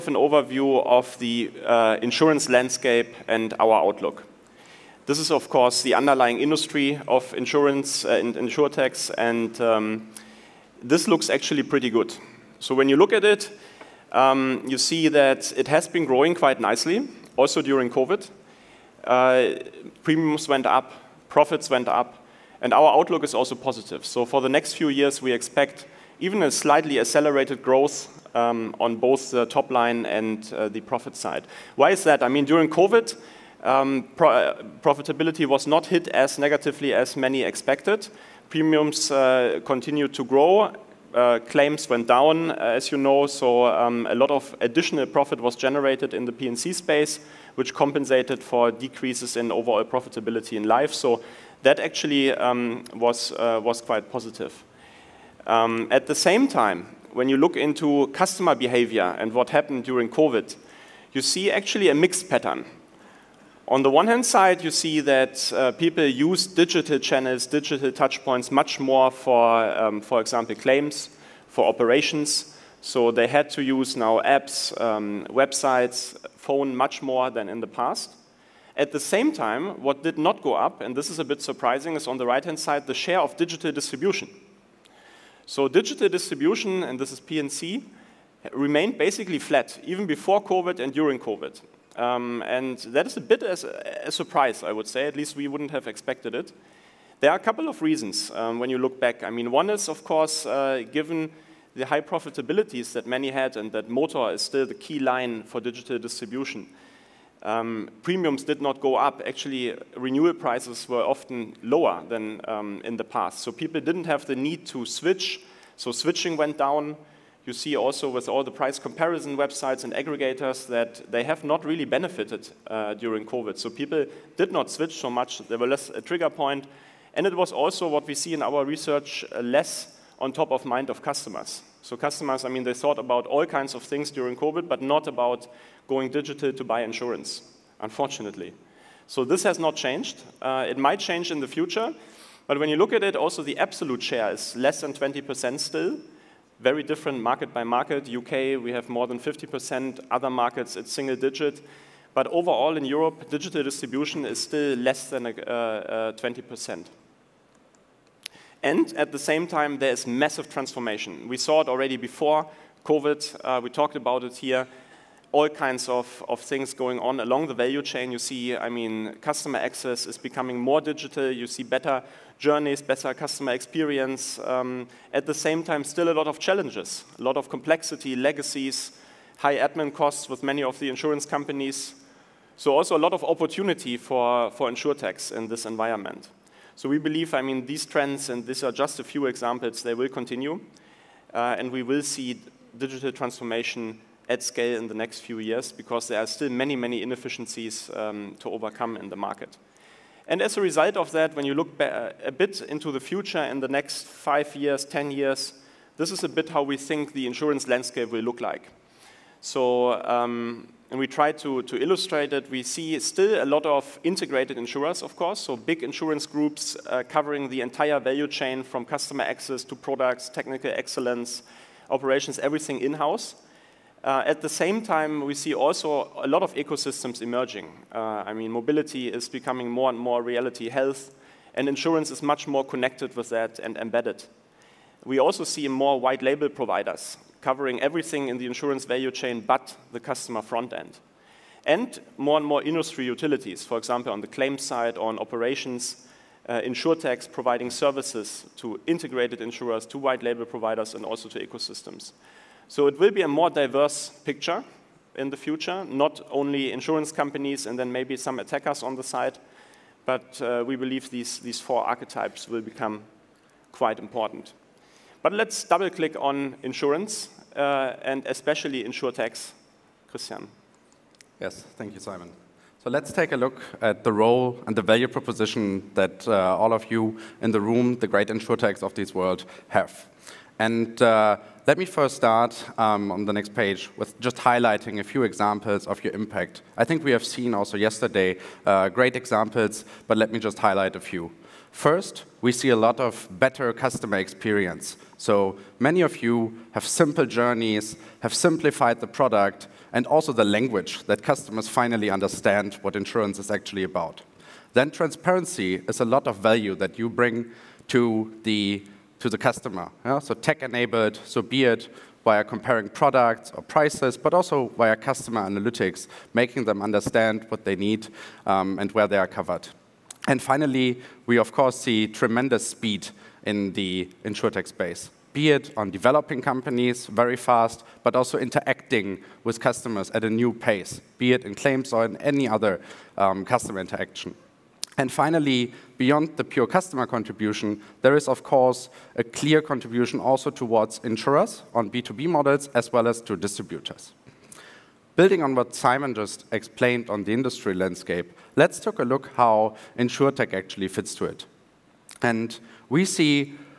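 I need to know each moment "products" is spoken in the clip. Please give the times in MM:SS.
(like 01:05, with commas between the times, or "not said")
03:39, 04:59, 05:12.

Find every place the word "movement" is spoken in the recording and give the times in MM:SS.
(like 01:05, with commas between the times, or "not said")
not said.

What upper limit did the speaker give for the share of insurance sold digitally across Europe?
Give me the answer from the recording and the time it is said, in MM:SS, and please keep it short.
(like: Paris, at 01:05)
Less than 20%, at 02:34.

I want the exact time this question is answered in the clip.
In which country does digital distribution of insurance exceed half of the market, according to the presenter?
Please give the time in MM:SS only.
02:28.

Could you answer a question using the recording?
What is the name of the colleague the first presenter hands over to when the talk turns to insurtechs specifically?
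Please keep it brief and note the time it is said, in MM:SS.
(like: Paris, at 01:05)
Christian, at 04:30.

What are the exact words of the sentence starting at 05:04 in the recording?
Then transparency is a lot of value that you bring to the to the customer.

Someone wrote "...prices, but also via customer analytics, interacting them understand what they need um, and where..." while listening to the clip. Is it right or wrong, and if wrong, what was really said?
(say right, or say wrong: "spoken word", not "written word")
wrong: "making", not "interacting".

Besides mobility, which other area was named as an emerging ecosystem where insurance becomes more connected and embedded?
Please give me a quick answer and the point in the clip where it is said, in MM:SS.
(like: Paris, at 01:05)
Health, at 03:50.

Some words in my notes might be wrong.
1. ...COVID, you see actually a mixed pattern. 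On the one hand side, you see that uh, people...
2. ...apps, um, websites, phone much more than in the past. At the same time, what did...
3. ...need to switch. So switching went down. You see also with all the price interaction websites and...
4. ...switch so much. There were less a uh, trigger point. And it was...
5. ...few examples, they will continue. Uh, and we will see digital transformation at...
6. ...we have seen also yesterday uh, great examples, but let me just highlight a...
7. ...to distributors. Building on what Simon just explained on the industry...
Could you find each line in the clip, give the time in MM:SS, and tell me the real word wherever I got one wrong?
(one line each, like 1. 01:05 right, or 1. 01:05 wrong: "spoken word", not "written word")
1. 01:00 right
2. 01:14 right
3. 01:54 wrong: "comparison", not "interaction"
4. 02:04 right
5. 03:09 right
6. 04:47 right
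7. 05:43 right.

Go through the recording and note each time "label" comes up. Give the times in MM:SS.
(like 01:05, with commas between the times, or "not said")
03:56, 04:10.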